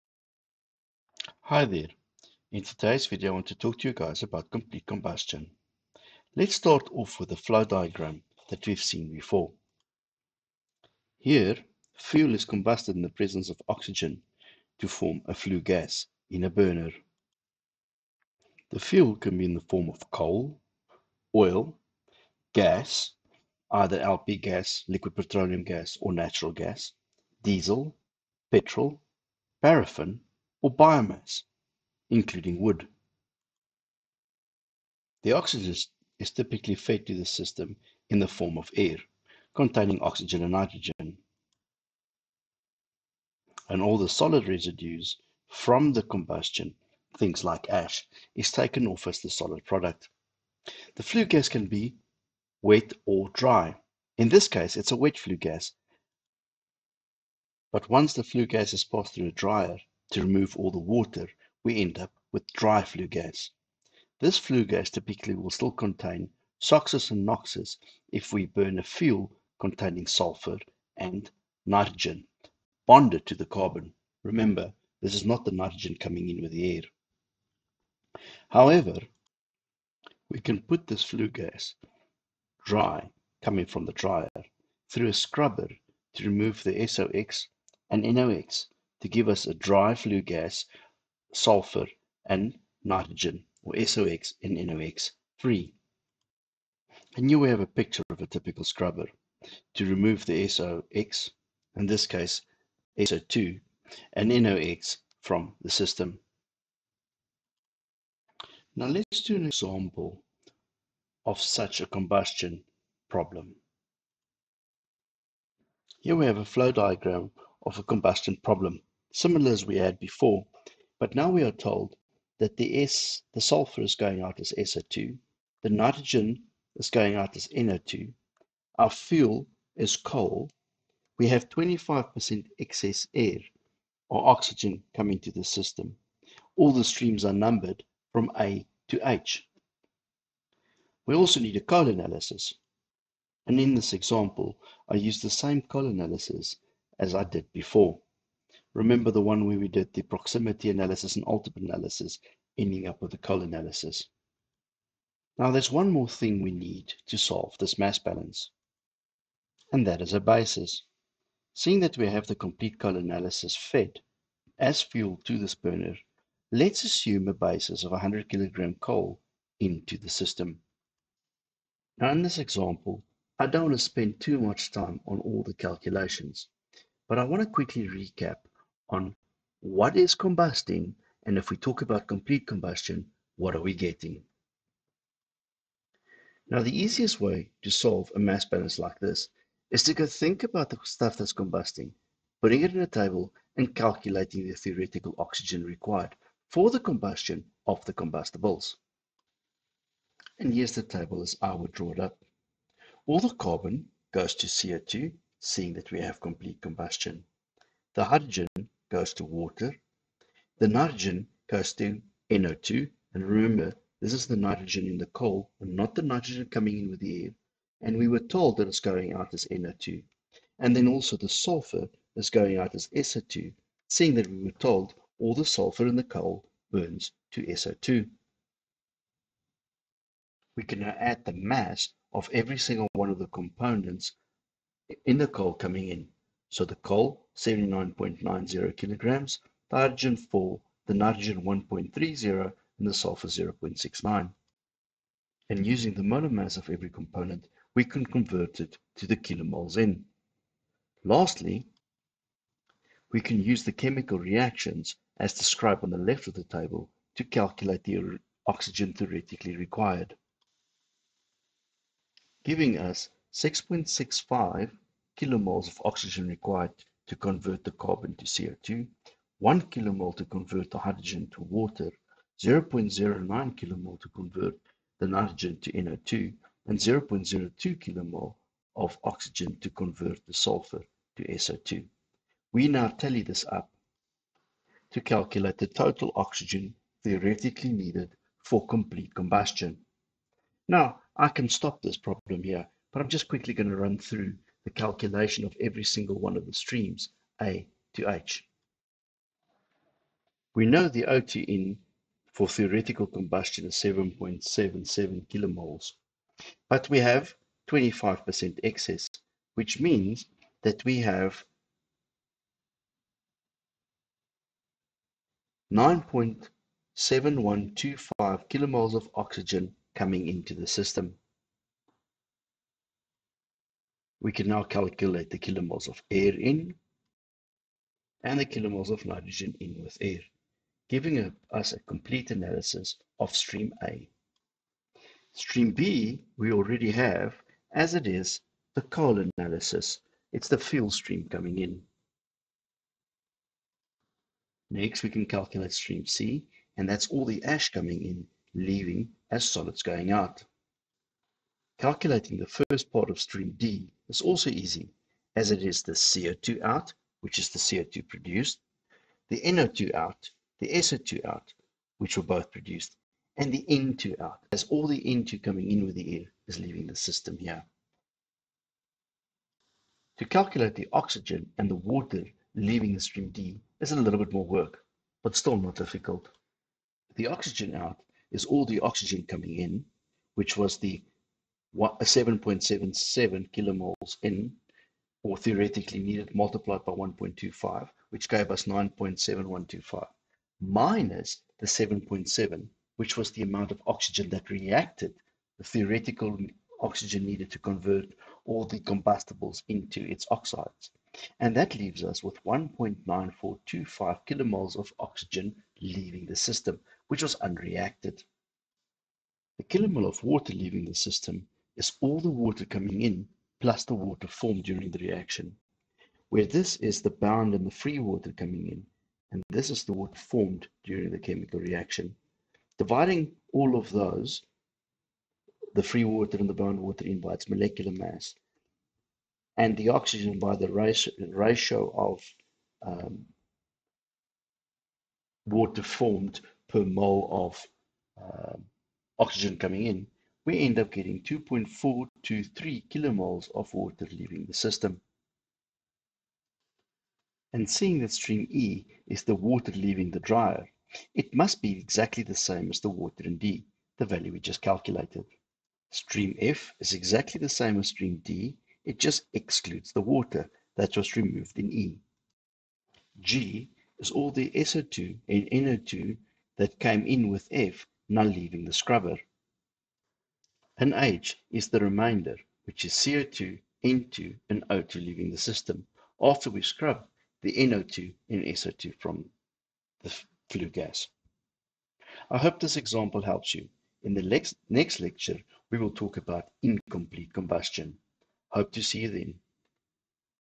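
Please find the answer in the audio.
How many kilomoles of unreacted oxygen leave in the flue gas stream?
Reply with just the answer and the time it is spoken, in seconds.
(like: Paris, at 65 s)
1.9425, at 402 s.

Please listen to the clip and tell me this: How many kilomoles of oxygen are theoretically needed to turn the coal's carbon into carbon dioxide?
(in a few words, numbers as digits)
6.65.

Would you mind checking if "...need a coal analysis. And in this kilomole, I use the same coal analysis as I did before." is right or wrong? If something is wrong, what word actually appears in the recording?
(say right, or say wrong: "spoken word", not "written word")
wrong: "example", not "kilomole".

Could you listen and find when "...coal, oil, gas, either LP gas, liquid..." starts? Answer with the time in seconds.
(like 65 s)
20 s.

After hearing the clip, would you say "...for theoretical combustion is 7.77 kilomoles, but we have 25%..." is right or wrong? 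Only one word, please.
right.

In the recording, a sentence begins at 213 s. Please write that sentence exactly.
And remember, this is the nitrogen in the coal, and not the nitrogen coming in with the air.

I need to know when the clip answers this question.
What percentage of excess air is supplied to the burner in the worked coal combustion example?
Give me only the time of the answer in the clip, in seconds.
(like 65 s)
131 s.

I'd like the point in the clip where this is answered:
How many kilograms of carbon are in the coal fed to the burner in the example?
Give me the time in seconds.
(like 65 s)
237 s.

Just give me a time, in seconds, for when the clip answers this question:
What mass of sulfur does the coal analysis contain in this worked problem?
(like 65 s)
243 s.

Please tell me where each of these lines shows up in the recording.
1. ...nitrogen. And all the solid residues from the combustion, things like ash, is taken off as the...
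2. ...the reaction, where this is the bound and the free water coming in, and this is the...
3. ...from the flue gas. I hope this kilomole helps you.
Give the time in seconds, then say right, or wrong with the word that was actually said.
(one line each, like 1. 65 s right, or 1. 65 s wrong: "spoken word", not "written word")
1. 40 s right
2. 414 s right
3. 478 s wrong: "example", not "kilomole".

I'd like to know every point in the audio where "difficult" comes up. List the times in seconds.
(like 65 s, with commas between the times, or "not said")
375 s.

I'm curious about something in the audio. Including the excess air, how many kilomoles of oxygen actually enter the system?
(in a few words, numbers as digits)
9.7125.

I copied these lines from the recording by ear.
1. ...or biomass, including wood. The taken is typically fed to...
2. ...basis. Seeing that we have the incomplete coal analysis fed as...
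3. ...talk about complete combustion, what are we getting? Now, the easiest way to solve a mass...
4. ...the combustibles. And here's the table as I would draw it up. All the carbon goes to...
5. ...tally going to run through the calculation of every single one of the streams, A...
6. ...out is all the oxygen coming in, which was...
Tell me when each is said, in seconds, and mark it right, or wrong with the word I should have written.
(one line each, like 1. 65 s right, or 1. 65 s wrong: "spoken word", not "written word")
1. 30 s wrong: "oxygen", not "taken"
2. 160 s wrong: "complete", not "incomplete"
3. 181 s right
4. 197 s right
5. 293 s wrong: "quickly", not "tally"
6. 377 s right.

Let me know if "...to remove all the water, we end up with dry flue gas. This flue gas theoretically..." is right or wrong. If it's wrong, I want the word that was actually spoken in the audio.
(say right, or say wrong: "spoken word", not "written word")
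wrong: "typically", not "theoretically".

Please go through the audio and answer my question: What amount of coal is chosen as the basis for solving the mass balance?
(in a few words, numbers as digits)
100 kilograms.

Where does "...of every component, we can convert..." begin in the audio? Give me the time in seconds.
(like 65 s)
246 s.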